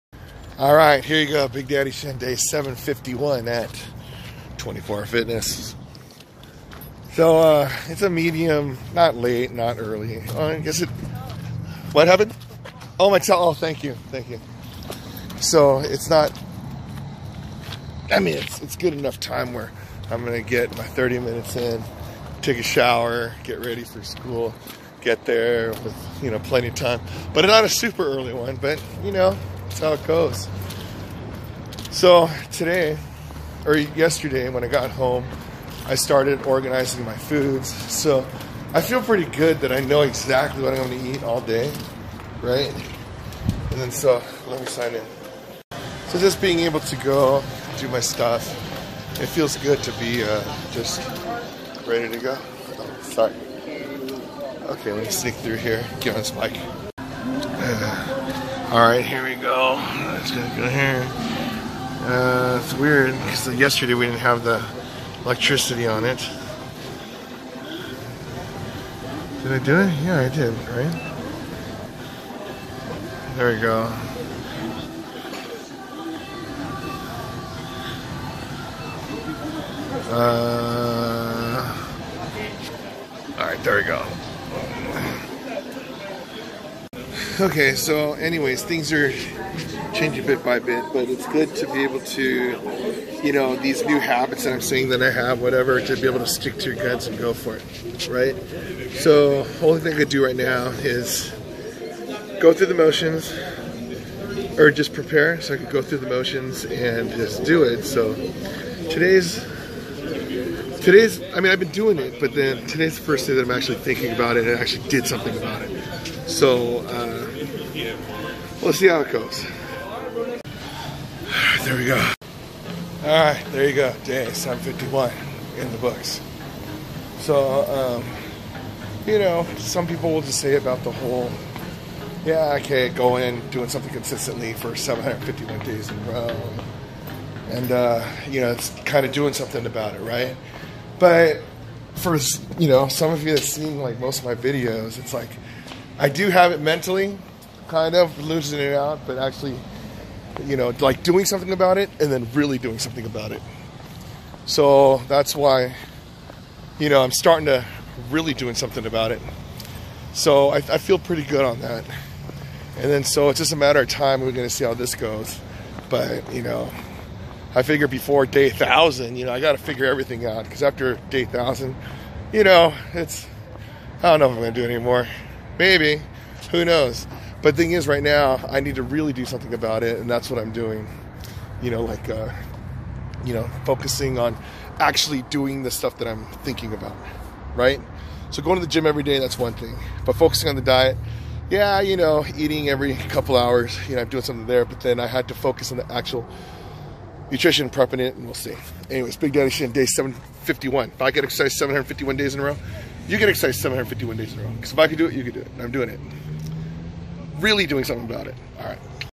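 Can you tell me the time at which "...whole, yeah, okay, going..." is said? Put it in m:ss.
2:10.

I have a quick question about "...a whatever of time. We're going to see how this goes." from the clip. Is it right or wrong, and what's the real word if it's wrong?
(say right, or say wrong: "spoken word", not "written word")
wrong: "matter", not "whatever".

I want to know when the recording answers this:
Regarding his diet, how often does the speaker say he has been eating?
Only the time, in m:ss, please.
3:12.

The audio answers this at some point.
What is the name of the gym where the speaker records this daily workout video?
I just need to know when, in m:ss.
0:04.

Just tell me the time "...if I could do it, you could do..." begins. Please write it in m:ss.
3:24.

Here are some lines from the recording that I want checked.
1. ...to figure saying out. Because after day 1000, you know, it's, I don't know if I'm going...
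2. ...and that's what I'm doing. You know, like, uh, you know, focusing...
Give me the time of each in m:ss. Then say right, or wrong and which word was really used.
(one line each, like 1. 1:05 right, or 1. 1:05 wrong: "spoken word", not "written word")
1. 2:49 wrong: "everything", not "saying"
2. 2:59 right.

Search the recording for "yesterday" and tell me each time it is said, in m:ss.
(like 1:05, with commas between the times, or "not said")
0:33, 1:03.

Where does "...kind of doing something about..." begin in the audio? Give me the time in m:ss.
2:18.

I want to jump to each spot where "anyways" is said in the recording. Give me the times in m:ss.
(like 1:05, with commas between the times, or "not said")
1:28, 3:18.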